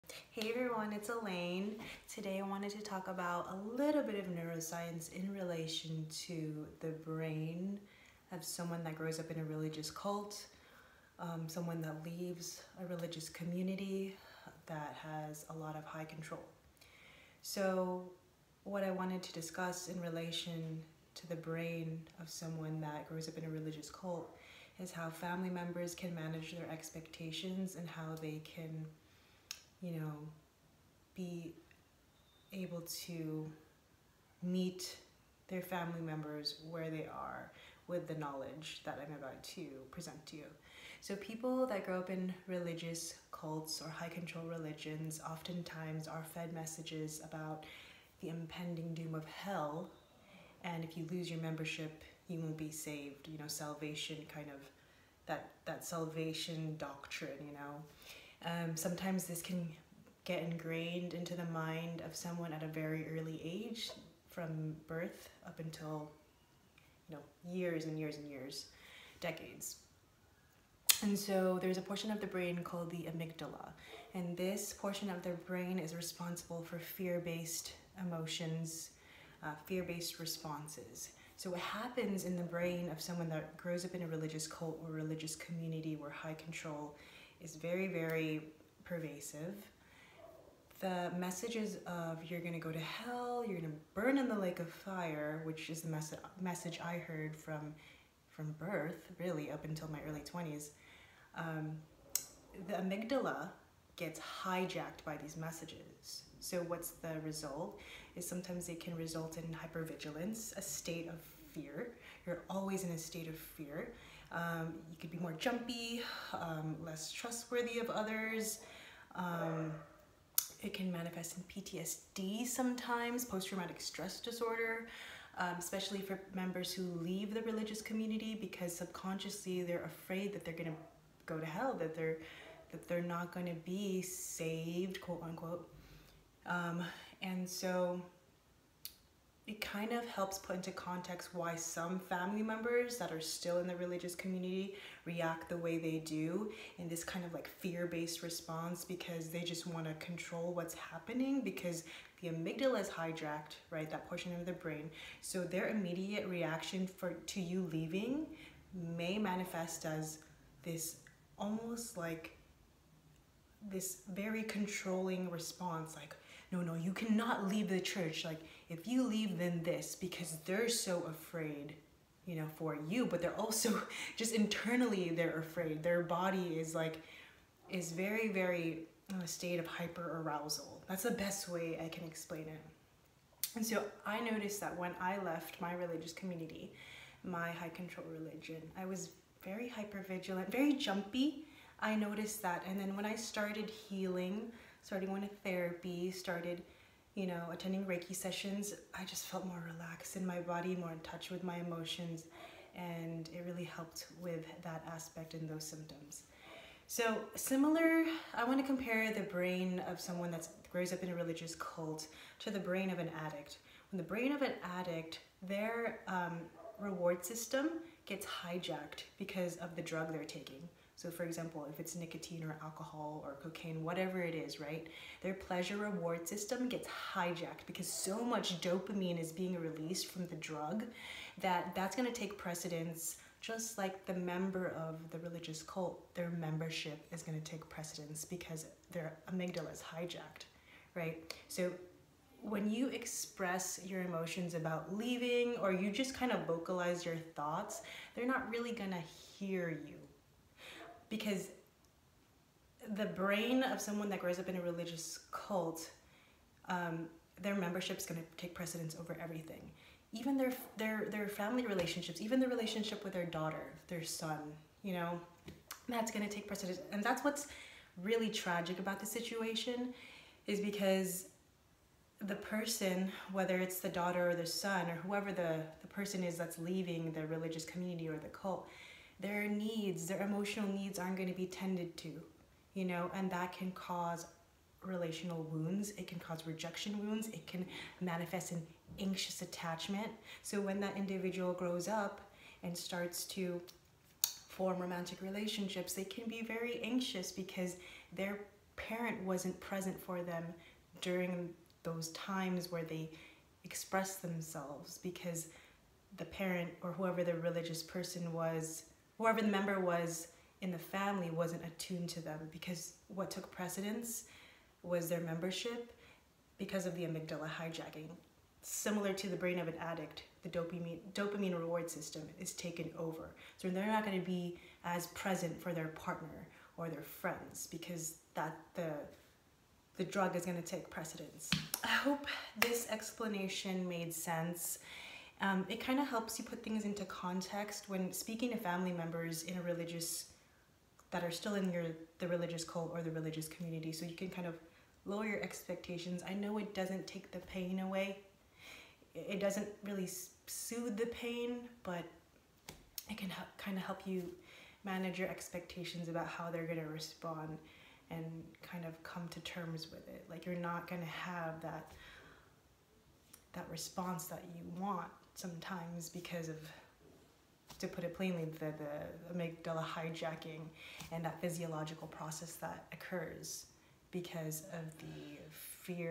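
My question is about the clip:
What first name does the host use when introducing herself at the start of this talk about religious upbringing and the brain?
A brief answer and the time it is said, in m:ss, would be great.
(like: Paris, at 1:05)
Elaine, at 0:01.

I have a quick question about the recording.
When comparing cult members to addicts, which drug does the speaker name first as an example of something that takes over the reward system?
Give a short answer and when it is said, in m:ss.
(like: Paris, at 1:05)
nicotine, at 3:41.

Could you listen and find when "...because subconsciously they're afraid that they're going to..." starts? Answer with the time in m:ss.
2:08.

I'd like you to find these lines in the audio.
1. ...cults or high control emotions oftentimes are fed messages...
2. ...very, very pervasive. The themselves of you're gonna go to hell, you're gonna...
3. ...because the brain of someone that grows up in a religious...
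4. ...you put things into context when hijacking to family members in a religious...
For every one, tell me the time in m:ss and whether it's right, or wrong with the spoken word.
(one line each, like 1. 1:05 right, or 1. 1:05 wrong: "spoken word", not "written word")
1. 0:43 wrong: "religions", not "emotions"
2. 1:27 wrong: "messages", not "themselves"
3. 4:11 right
4. 5:36 wrong: "speaking", not "hijacking".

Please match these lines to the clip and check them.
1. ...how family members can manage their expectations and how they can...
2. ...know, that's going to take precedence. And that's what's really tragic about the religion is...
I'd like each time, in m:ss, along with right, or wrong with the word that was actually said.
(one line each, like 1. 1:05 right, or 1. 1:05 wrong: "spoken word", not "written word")
1. 0:24 right
2. 4:24 wrong: "situation", not "religion".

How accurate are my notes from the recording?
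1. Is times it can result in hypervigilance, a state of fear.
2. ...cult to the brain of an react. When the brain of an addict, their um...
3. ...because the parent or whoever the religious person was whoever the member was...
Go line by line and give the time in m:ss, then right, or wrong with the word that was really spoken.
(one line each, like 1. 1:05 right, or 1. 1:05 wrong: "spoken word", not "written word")
1. 1:48 wrong: "sometimes", not "times"
2. 3:31 wrong: "addict", not "react"
3. 5:04 right.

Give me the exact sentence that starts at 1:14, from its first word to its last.
And this portion of the brain is responsible for fear-based emotions, uh, fear-based responses.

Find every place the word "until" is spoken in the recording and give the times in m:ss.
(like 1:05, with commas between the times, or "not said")
1:05, 1:39.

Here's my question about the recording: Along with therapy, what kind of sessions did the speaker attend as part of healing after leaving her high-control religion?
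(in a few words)
Reiki sessions.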